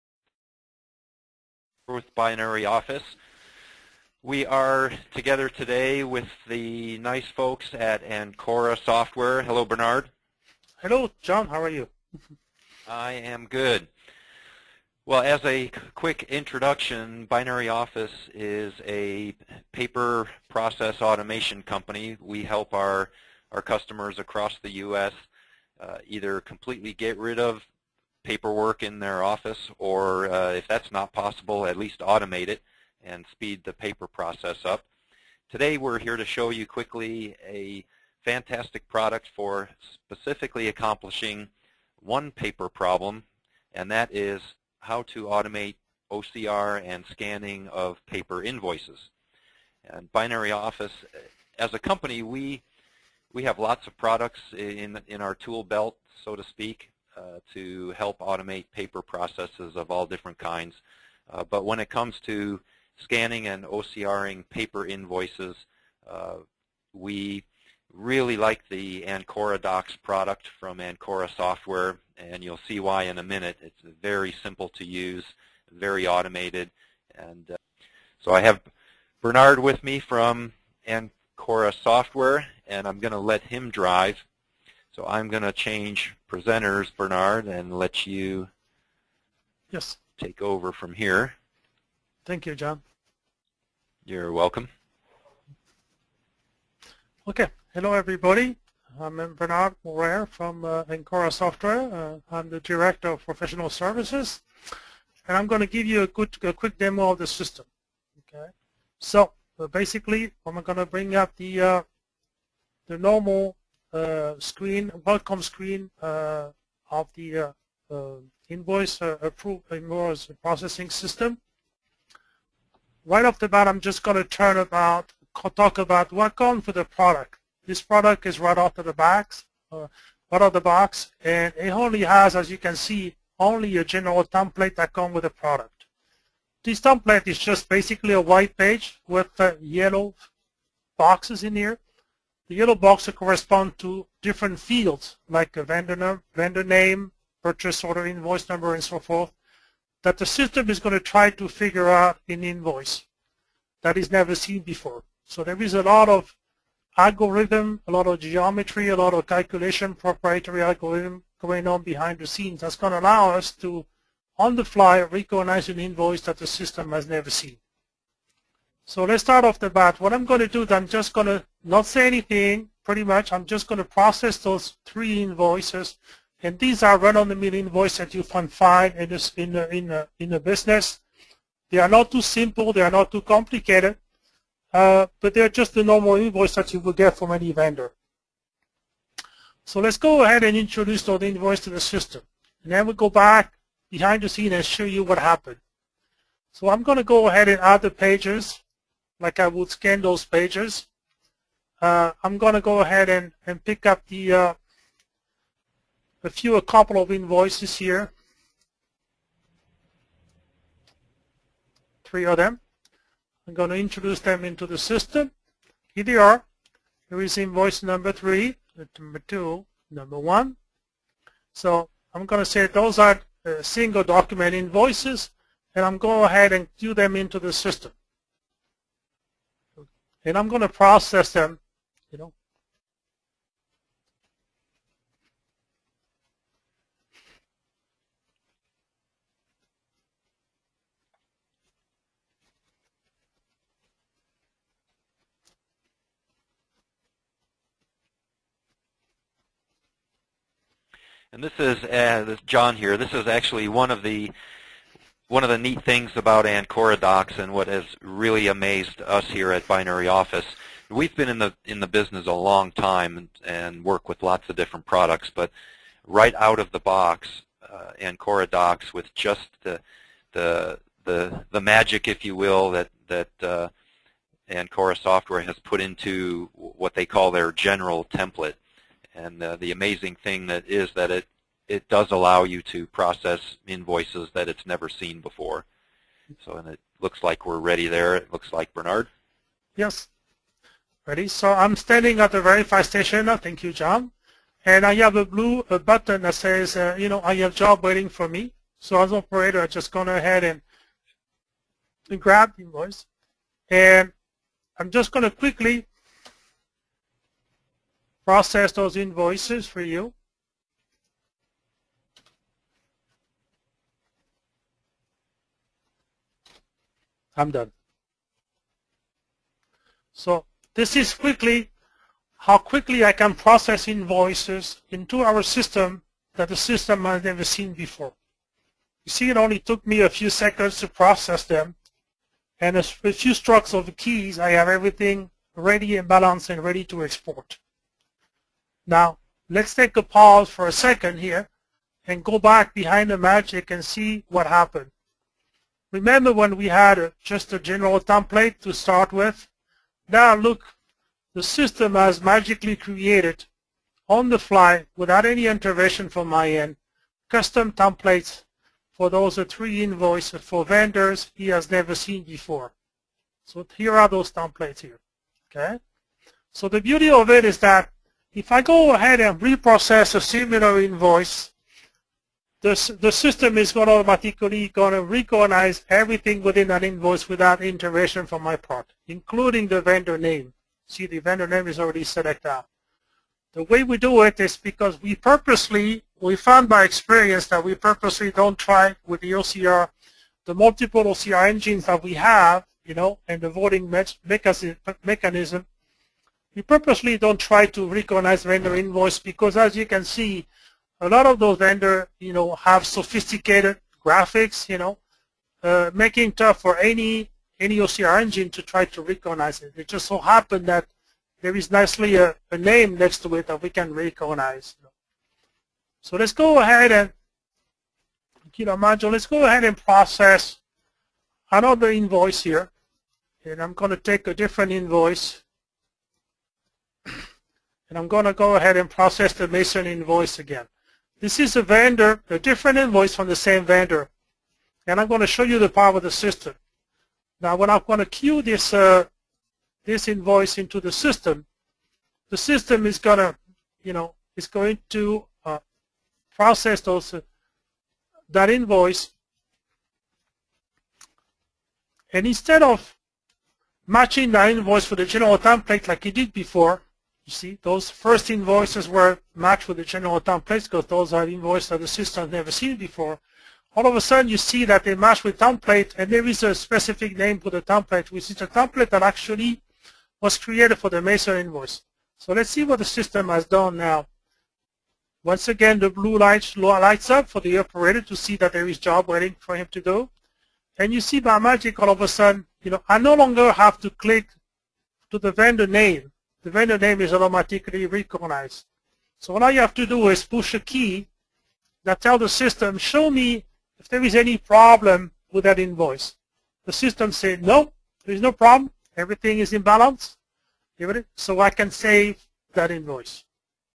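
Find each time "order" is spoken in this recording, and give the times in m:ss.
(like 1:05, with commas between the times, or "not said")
2:27.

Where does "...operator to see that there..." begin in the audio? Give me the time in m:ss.
7:57.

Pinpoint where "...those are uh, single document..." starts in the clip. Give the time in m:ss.
3:42.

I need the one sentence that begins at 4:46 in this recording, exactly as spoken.
So, and it looks like we're ready there.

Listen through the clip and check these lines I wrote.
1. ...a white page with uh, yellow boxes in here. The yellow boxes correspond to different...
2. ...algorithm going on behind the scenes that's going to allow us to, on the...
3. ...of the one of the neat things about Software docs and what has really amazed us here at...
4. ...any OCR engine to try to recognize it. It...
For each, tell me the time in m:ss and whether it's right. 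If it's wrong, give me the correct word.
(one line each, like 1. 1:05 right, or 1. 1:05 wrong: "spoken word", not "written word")
1. 2:18 right
2. 2:40 right
3. 4:13 wrong: "Ancora", not "Software"
4. 6:47 right.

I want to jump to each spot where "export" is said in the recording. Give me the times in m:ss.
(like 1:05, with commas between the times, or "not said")
5:37.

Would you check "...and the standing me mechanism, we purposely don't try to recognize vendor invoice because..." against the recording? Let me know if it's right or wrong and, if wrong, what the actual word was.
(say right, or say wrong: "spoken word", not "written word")
wrong: "voting", not "standing".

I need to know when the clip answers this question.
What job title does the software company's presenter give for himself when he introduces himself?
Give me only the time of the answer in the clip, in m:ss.
1:42.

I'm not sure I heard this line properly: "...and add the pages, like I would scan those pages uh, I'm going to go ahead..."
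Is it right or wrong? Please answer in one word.
right.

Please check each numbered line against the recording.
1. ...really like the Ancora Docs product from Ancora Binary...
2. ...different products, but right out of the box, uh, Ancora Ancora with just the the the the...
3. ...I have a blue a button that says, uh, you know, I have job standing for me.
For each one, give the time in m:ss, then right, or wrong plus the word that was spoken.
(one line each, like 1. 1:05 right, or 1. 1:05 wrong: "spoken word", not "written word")
1. 1:07 wrong: "Software", not "Binary"
2. 4:24 wrong: "Docs", not "Ancora"
3. 4:54 wrong: "waiting", not "standing".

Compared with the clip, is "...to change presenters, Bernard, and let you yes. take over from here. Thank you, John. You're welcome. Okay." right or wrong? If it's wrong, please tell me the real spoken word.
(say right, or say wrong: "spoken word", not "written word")
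right.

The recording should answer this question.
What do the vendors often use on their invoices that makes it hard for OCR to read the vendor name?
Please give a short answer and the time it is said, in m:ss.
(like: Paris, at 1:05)
Sophisticated graphics, at 6:42.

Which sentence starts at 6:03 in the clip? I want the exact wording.
So here are those templates here.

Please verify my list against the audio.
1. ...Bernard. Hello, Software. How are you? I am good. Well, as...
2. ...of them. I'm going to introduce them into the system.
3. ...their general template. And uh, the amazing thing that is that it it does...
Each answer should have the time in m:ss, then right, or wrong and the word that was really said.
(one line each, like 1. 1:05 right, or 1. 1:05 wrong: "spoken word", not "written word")
1. 0:09 wrong: "John", not "Software"
2. 3:32 right
3. 4:37 right.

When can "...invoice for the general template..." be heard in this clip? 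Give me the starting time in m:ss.
7:34.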